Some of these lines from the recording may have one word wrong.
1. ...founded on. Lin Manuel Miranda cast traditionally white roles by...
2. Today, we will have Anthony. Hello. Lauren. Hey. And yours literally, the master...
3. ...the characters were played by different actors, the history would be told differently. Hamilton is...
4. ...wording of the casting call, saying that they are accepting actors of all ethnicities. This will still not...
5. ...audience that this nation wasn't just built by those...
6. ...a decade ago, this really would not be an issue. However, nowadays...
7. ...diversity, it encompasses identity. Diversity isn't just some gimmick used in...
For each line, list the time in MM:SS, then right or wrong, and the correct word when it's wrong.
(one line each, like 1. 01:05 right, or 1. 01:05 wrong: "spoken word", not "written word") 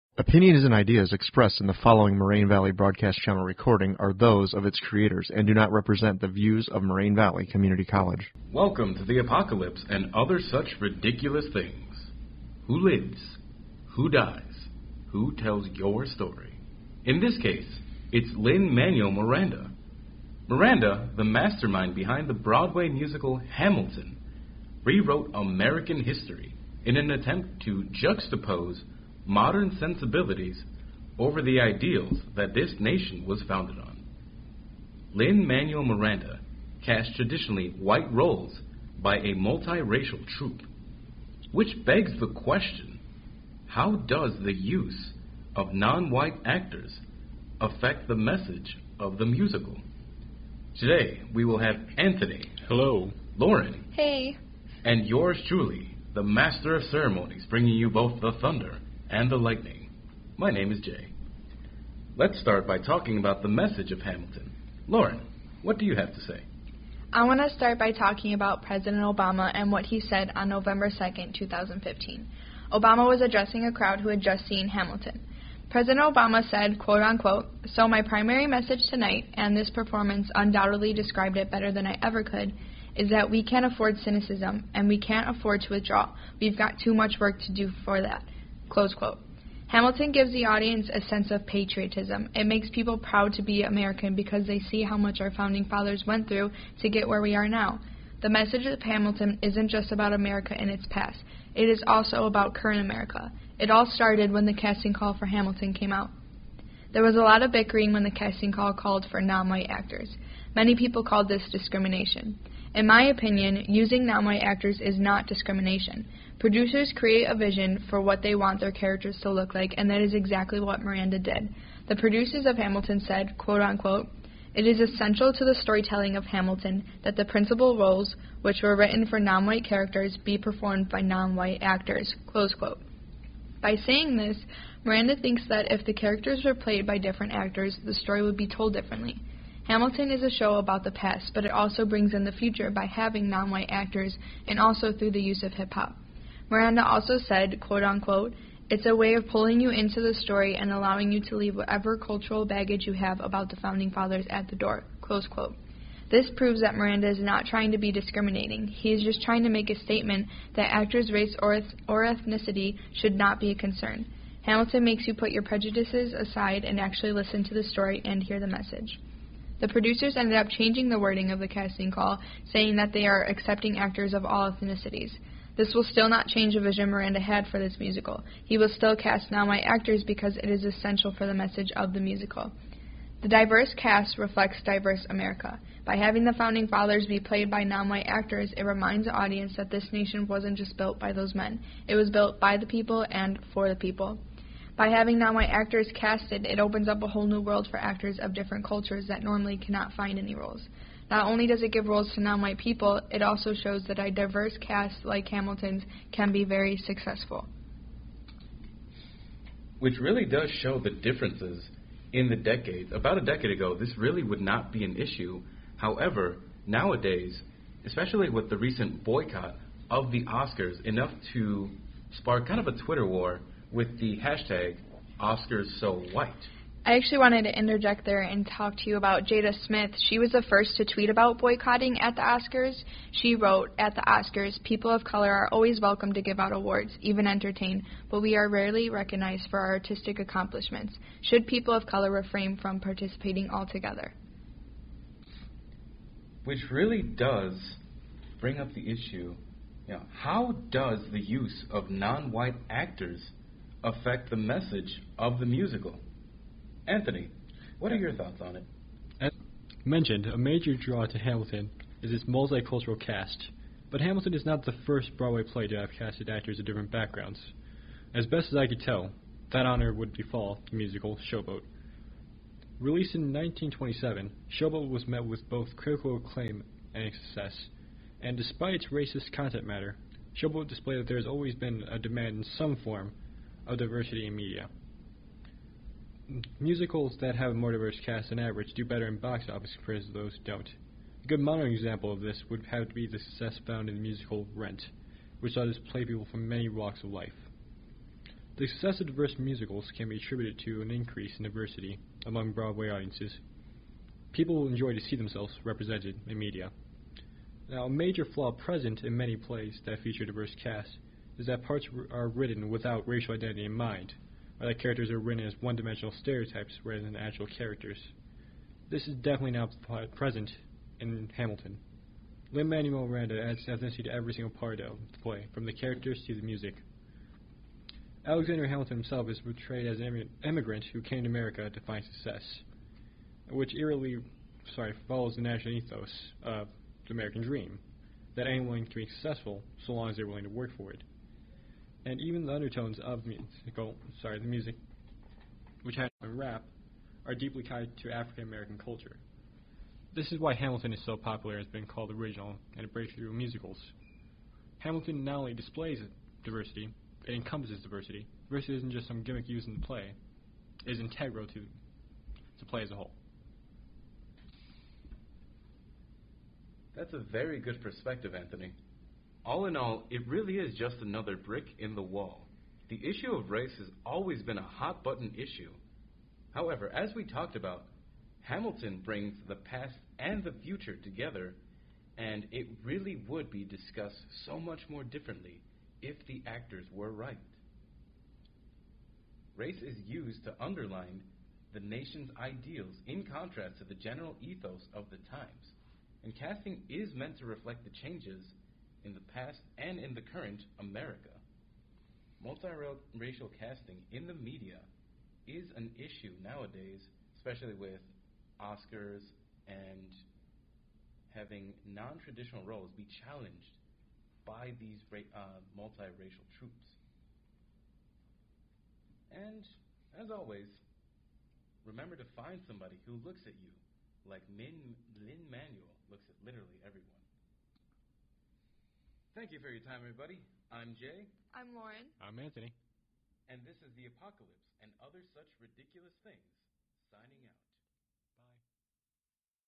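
1. 00:33 right
2. 00:50 wrong: "truly", not "literally"
3. 02:15 wrong: "story", not "history"
4. 02:50 right
5. 03:09 right
6. 03:33 right
7. 05:56 wrong: "diversity", not "identity".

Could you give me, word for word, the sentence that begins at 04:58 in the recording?
The success of diverse musicals can be attributed to an increase in diversity among Broadway audiences.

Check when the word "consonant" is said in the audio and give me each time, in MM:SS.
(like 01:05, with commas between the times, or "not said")
not said.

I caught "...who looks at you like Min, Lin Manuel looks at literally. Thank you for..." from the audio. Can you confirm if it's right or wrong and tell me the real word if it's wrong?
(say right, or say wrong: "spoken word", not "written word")
right.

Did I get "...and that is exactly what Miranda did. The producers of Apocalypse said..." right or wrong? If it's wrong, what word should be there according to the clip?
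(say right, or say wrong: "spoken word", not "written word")
wrong: "Hamilton", not "Apocalypse".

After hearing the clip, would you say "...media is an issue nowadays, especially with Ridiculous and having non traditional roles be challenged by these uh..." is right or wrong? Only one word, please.
wrong.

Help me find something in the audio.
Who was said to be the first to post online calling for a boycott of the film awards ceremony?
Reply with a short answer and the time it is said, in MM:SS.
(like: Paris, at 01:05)
Jada Smith, at 03:49.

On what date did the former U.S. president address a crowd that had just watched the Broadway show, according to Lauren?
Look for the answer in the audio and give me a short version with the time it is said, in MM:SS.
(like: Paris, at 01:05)
November 2nd, 2015, at 01:10.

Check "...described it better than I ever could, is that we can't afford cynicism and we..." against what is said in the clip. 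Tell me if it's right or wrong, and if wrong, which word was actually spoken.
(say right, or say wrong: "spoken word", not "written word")
right.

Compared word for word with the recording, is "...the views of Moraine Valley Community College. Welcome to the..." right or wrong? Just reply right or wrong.
right.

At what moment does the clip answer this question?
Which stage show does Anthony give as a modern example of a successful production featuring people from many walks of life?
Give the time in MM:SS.
04:54.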